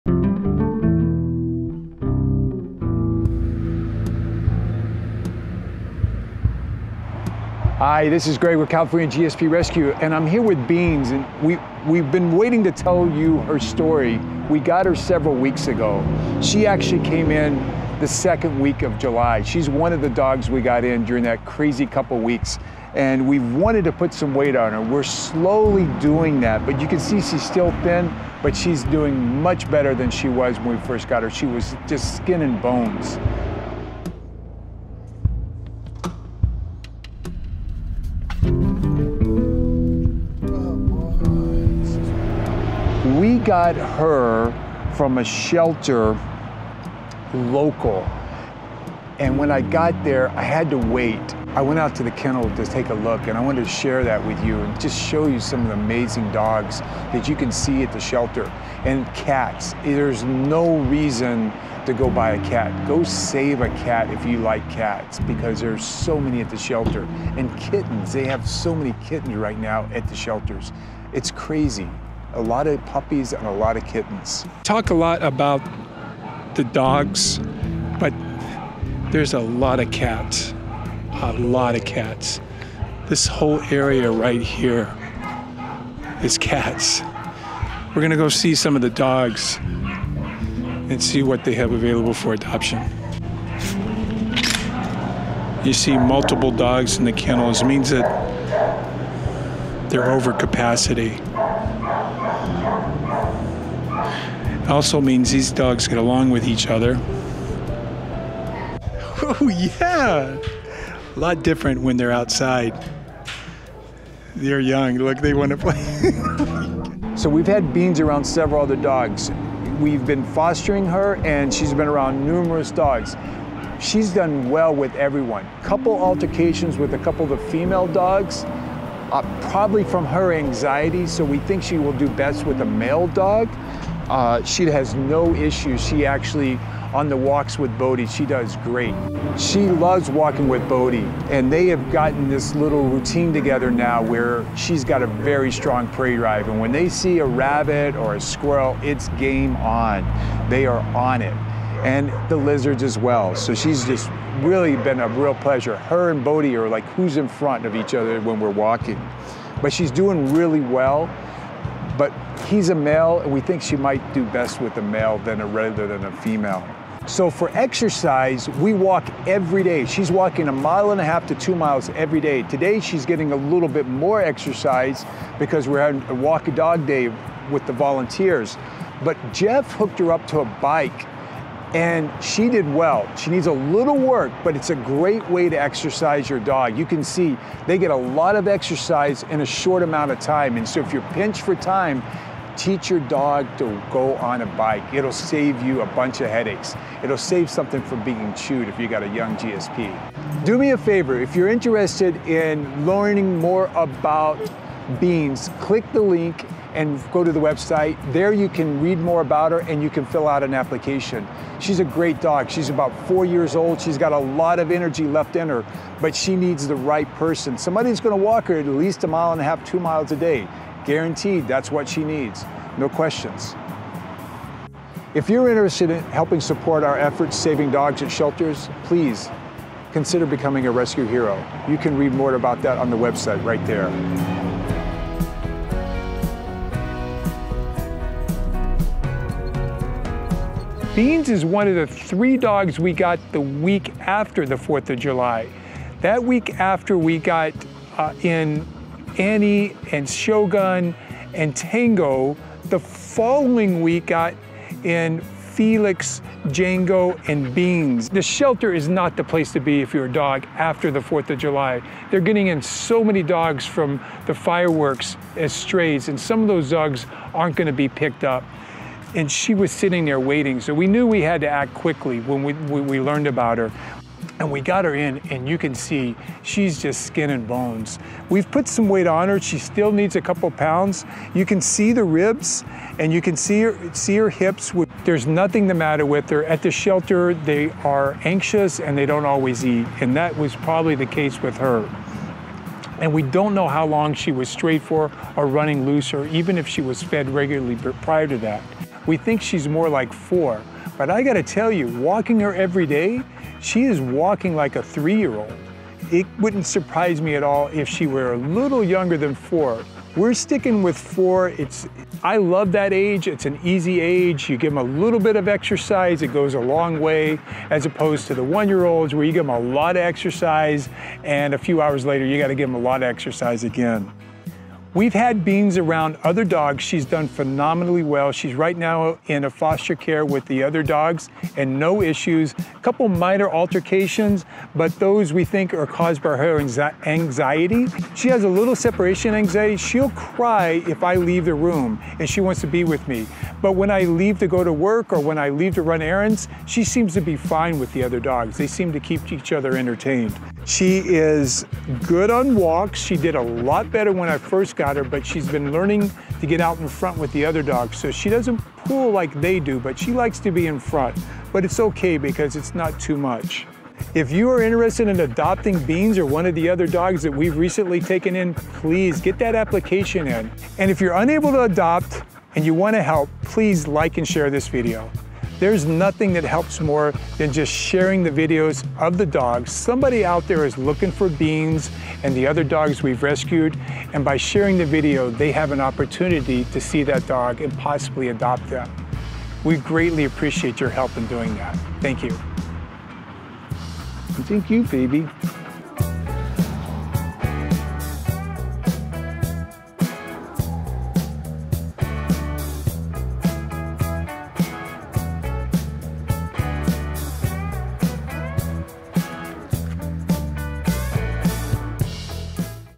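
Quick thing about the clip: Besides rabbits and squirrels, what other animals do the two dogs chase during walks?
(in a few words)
Lizards.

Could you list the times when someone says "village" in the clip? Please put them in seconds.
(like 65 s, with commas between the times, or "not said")
not said.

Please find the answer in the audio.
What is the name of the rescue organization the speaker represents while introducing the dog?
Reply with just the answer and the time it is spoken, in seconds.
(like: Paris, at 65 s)
California GSP Rescue, at 8 s.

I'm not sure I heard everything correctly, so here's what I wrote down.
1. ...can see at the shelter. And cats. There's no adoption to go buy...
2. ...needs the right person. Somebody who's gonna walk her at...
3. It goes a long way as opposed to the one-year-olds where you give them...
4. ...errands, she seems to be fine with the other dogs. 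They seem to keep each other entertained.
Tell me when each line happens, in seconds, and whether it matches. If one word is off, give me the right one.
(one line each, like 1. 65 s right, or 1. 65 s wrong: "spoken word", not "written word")
1. 57 s wrong: "reason", not "adoption"
2. 216 s right
3. 316 s right
4. 346 s right.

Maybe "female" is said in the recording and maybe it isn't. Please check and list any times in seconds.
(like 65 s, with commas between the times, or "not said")
127 s, 166 s.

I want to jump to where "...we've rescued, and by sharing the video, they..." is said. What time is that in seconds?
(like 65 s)
383 s.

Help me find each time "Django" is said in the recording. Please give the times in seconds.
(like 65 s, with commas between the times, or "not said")
256 s.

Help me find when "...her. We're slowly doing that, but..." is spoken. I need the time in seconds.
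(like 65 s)
24 s.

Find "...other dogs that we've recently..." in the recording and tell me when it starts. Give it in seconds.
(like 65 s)
366 s.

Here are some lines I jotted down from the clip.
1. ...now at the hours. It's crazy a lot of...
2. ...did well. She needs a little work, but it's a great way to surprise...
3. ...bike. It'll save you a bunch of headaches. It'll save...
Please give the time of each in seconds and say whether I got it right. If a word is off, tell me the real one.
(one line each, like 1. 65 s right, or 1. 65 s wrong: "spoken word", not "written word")
1. 69 s wrong: "shelters", not "hours"
2. 182 s wrong: "exercise", not "surprise"
3. 194 s right.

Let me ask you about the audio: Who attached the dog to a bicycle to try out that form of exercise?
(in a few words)
Jeff.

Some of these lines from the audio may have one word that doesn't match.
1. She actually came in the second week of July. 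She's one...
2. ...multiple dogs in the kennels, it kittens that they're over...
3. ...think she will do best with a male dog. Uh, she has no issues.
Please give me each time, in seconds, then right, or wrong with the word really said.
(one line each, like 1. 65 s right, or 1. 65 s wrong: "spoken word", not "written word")
1. 16 s right
2. 95 s wrong: "means", not "kittens"
3. 131 s right.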